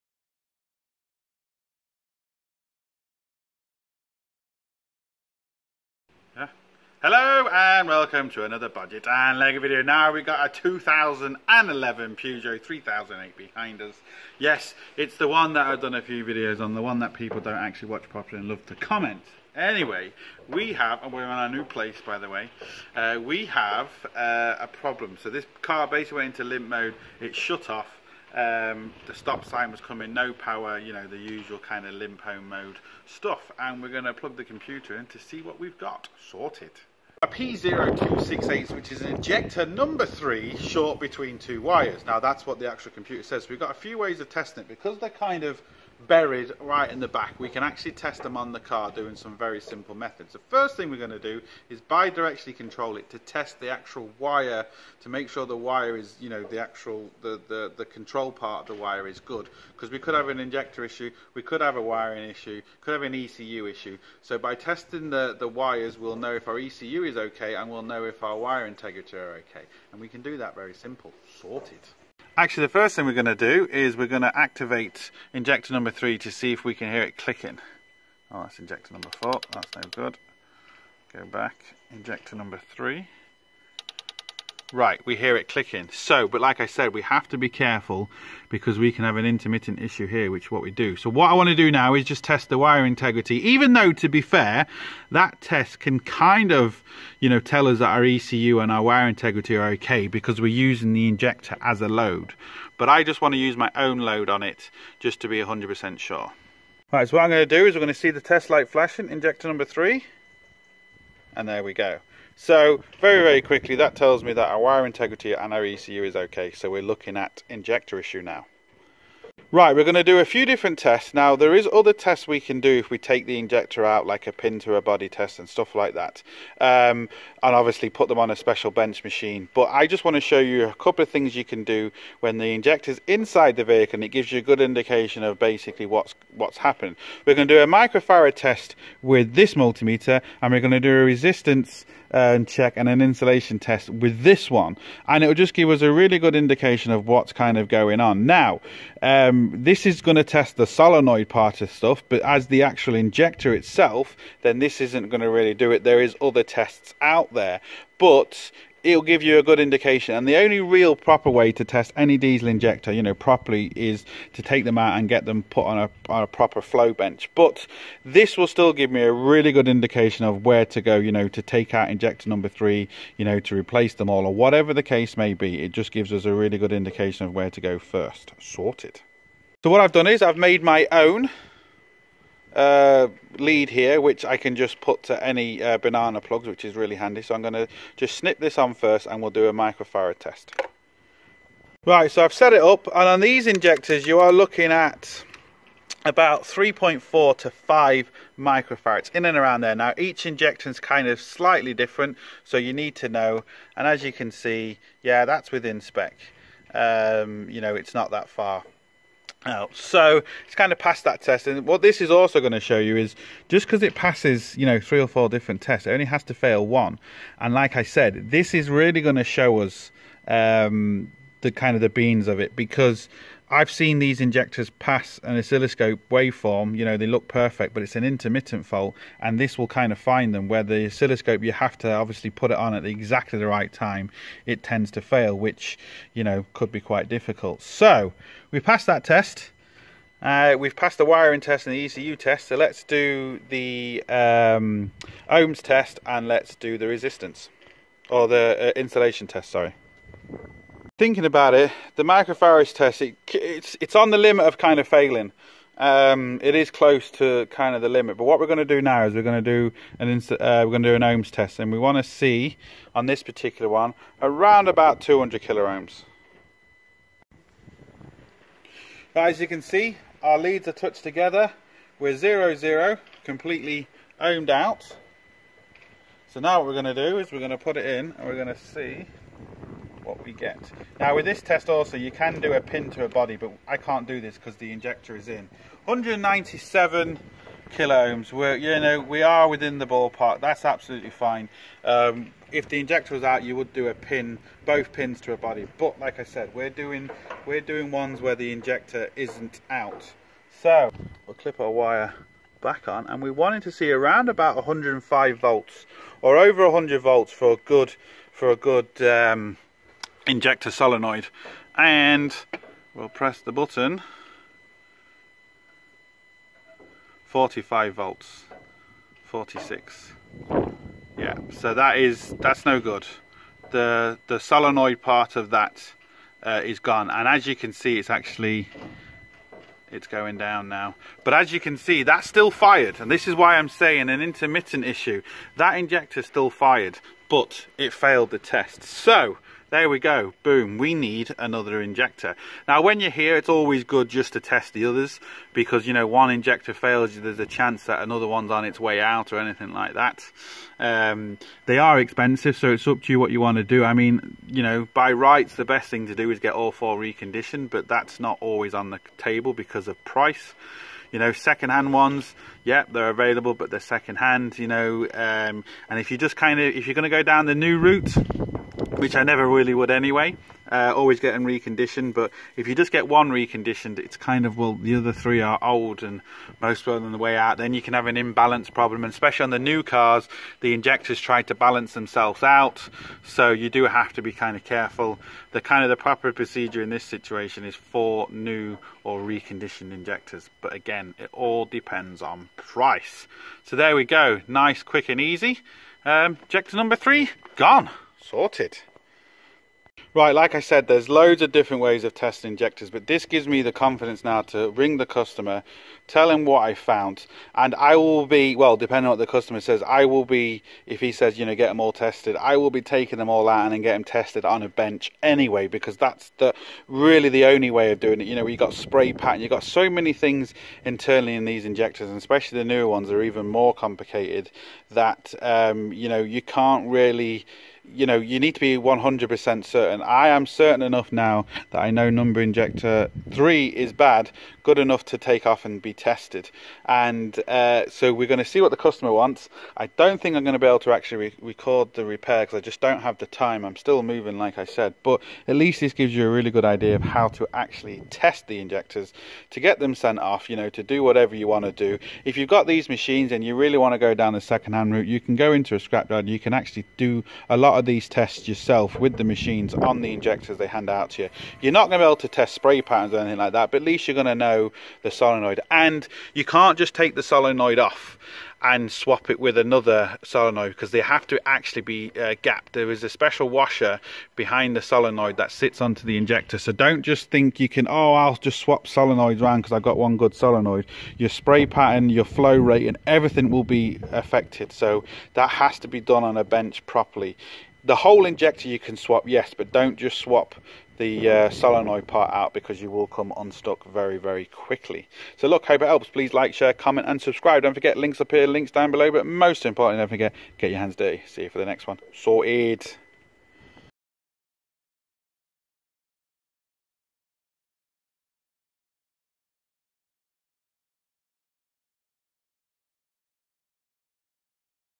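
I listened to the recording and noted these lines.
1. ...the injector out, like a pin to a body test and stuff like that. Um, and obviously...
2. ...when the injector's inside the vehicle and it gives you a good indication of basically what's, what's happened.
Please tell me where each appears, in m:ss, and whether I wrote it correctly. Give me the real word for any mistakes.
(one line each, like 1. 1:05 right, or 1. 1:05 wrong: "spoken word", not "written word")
1. 2:03 right
2. 2:12 right.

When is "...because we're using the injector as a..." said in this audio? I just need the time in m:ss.
1:40.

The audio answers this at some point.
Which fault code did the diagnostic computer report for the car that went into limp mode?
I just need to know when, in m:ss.
0:37.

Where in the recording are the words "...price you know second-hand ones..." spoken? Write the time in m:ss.
6:00.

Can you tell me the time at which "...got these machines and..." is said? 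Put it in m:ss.
7:32.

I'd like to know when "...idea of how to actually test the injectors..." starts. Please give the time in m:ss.
7:26.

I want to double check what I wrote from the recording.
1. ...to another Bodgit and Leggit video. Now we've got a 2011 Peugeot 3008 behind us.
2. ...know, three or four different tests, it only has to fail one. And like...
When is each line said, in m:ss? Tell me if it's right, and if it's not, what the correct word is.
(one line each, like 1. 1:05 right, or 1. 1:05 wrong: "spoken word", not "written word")
1. 0:08 right
2. 3:34 right.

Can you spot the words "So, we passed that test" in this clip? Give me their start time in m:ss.
3:57.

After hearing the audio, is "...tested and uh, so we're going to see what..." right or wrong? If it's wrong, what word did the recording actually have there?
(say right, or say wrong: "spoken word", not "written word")
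right.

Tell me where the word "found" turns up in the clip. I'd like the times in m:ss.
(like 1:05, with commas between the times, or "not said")
6:46.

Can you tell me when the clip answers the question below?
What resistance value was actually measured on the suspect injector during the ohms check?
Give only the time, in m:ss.
4:45.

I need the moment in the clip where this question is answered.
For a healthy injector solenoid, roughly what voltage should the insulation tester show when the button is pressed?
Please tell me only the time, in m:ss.
5:04.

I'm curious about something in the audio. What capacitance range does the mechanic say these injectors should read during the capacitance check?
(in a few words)
3.4 to 5 microfarads.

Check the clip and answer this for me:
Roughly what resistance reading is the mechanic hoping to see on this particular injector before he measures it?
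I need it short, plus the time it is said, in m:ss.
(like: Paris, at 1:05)
200 kilo ohms, at 4:25.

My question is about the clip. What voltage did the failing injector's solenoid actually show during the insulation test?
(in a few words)
45 volts.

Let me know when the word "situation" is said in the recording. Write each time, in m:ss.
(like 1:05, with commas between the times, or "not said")
6:27.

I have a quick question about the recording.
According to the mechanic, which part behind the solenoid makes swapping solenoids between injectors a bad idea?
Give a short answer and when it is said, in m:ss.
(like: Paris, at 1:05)
a special washer, at 7:53.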